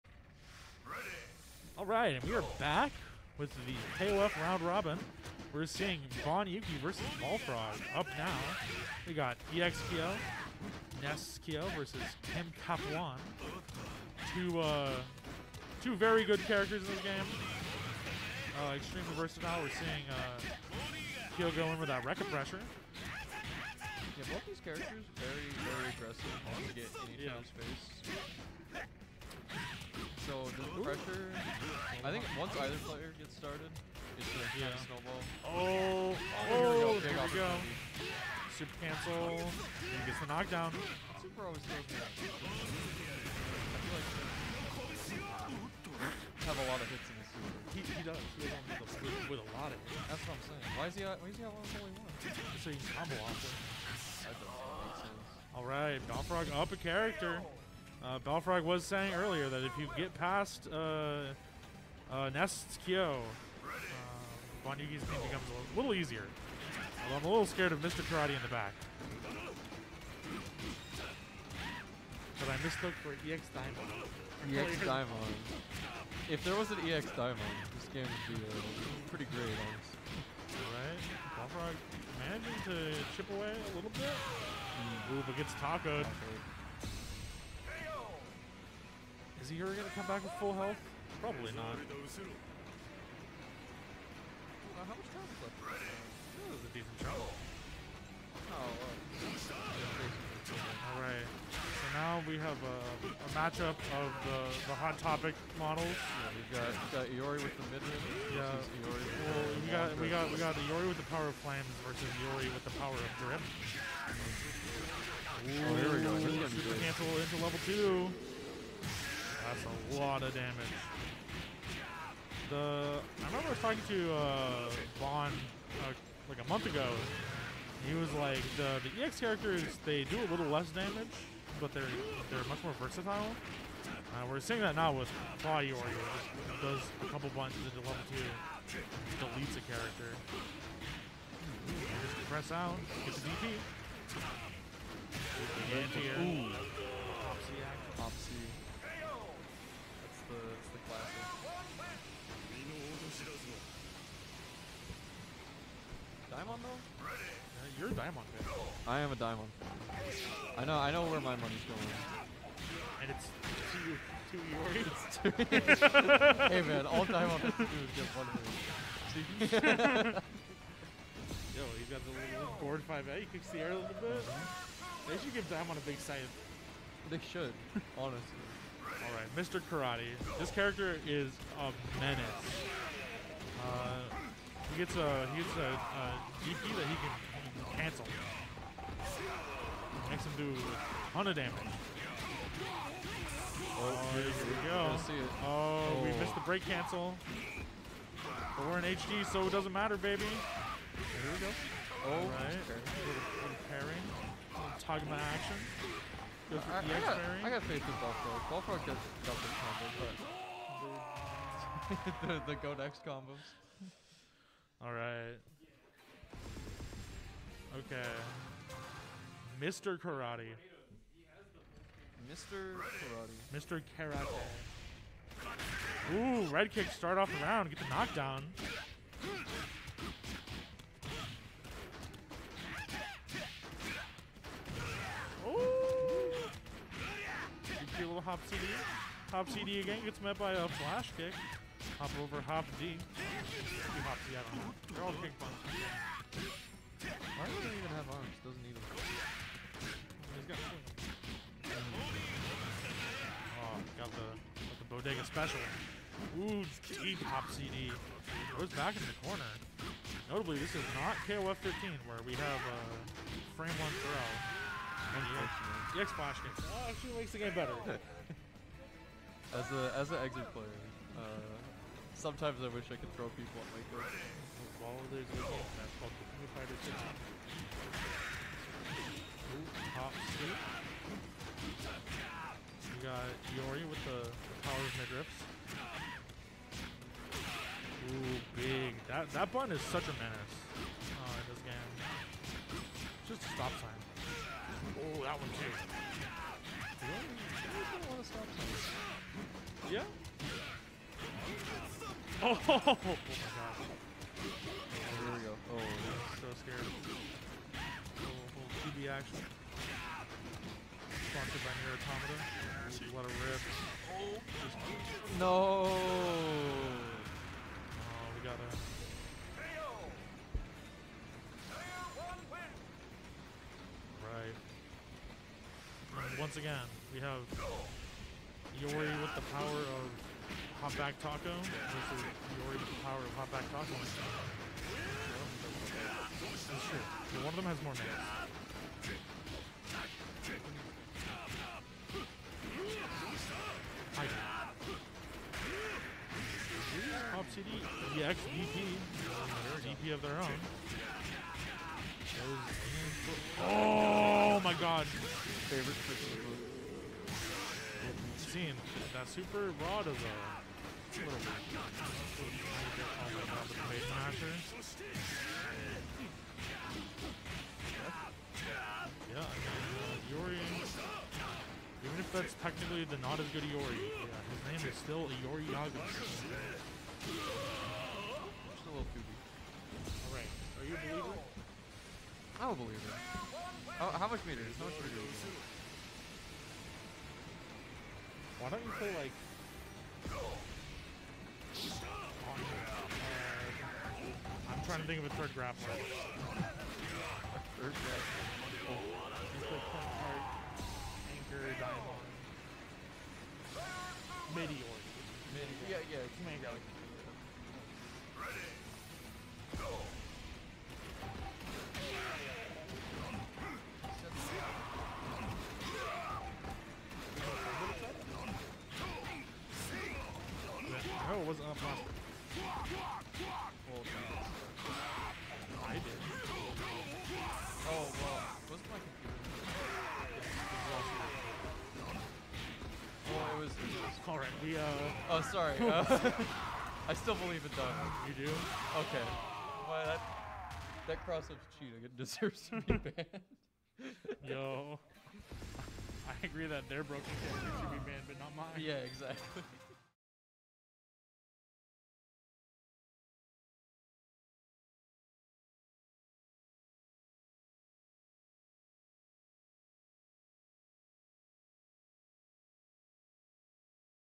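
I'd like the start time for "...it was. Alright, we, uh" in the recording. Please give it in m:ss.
7:13.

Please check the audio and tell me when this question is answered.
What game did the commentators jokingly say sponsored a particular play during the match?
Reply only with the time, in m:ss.
5:11.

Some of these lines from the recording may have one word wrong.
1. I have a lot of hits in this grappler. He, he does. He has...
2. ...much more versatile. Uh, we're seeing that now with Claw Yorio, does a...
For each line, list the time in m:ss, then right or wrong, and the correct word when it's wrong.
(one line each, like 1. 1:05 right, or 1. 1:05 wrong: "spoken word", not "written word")
1. 0:45 wrong: "super", not "grappler"
2. 2:12 right.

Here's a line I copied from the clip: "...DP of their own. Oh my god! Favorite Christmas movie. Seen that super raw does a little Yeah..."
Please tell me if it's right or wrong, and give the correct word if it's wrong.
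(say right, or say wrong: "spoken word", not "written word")
right.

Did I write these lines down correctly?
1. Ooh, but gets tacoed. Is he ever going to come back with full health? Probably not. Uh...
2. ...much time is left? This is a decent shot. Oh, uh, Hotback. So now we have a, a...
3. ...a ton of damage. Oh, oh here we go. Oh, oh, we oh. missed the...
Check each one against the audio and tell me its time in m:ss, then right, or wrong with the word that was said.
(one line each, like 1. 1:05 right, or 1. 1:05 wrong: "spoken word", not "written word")
1. 1:25 right
2. 1:34 wrong: "Alright", not "Hotback"
3. 3:10 right.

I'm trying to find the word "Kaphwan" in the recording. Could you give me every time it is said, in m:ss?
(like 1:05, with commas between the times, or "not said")
0:12.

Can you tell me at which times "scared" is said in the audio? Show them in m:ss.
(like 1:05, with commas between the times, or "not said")
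1:07, 5:06.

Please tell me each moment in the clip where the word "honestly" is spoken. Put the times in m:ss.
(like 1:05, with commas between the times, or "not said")
1:19, 2:57.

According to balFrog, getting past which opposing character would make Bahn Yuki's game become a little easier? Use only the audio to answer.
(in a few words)
Nest Kyo.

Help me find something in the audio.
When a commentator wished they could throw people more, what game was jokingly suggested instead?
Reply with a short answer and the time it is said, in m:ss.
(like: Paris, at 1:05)
Fighter 6, at 4:36.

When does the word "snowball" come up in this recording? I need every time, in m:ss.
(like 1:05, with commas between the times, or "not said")
0:34.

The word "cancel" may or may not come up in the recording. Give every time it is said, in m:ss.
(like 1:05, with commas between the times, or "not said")
0:38, 1:56, 3:07, 3:16.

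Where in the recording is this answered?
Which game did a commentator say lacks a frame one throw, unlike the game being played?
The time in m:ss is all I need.
4:21.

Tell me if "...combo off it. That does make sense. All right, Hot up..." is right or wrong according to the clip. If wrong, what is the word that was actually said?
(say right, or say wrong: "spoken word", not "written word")
wrong: "Balfrog", not "Hot".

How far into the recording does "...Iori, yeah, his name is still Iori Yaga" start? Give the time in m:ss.
6:13.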